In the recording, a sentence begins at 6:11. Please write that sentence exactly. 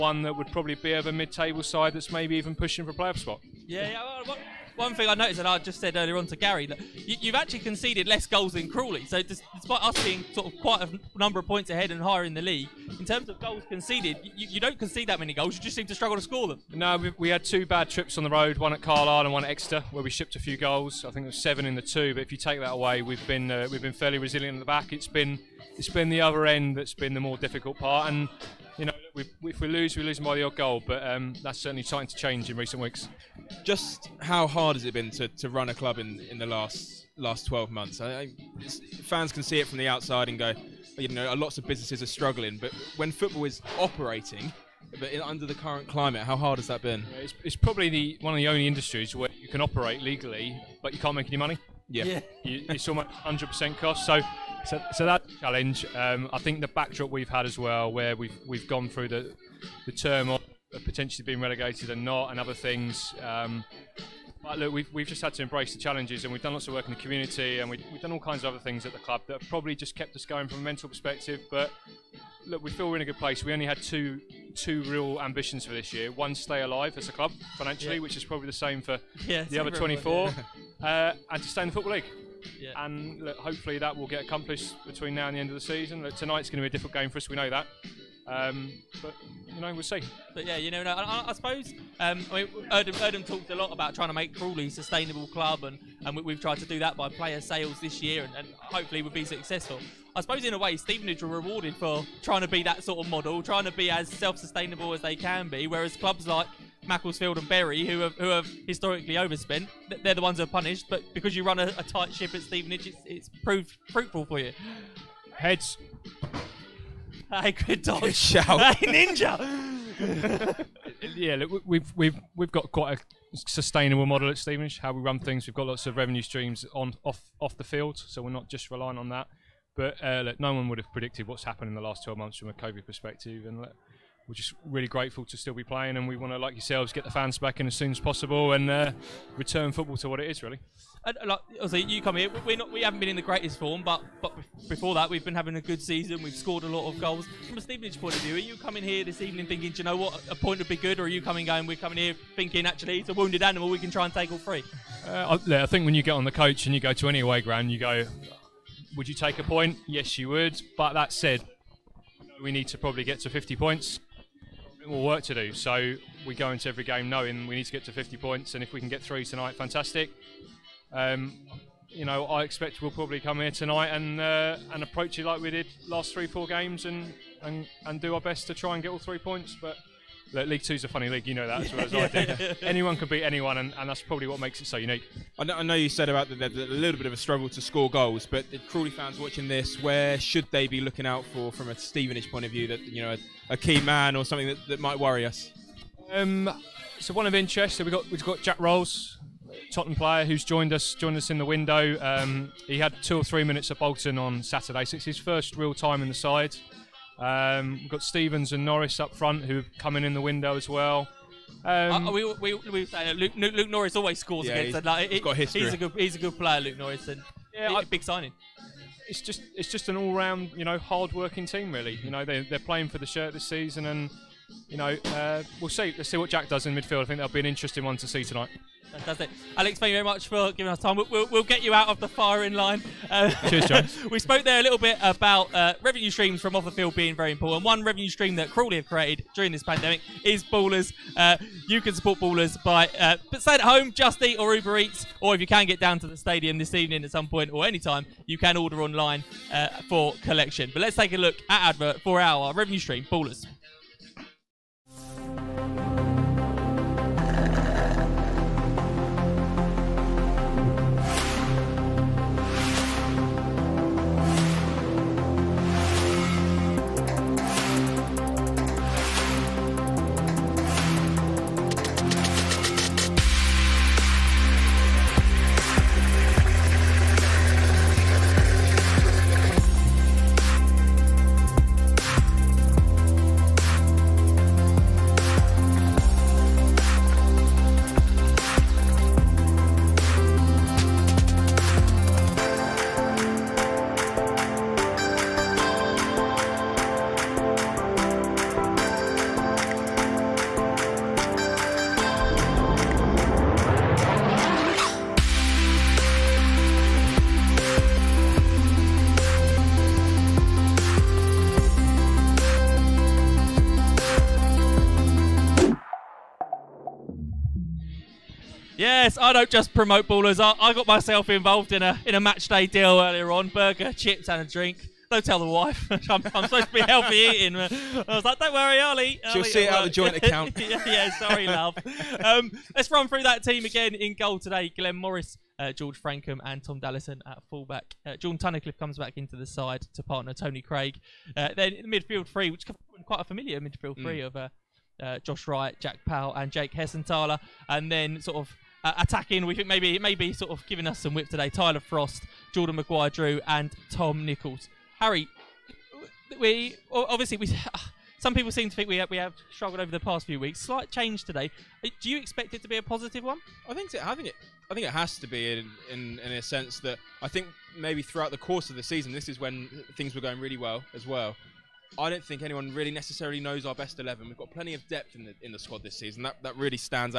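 I don't think anyone really necessarily knows our best 11.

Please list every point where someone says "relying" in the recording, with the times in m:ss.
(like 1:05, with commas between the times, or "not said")
2:08.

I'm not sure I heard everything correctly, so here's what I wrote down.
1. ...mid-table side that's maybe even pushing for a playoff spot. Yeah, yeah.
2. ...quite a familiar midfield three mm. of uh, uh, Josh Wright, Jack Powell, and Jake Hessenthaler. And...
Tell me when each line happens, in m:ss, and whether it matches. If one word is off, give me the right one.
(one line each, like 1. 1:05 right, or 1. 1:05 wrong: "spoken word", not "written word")
1. 0:01 right
2. 5:43 right.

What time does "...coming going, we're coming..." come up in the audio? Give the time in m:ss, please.
2:31.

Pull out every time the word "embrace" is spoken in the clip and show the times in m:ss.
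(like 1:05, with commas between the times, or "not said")
1:05.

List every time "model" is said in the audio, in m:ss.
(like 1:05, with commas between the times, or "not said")
1:43, 2:04.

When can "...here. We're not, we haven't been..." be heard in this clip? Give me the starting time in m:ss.
2:22.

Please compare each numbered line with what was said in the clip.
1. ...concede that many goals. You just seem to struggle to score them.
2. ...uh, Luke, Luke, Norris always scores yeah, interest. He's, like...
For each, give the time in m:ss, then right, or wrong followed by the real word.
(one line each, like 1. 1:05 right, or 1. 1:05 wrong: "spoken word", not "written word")
1. 0:14 right
2. 3:32 wrong: "against", not "interest".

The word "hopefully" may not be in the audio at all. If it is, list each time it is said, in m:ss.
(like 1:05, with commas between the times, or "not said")
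1:23, 1:38.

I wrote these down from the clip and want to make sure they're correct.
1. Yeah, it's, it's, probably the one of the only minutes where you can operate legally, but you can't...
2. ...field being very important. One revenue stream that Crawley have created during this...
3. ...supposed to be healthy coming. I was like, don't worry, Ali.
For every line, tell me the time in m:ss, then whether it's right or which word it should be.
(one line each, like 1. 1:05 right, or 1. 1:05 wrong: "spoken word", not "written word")
1. 0:47 wrong: "industries", not "minutes"
2. 3:56 right
3. 5:26 wrong: "eating", not "coming".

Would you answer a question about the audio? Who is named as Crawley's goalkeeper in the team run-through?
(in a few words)
Glenn Morris.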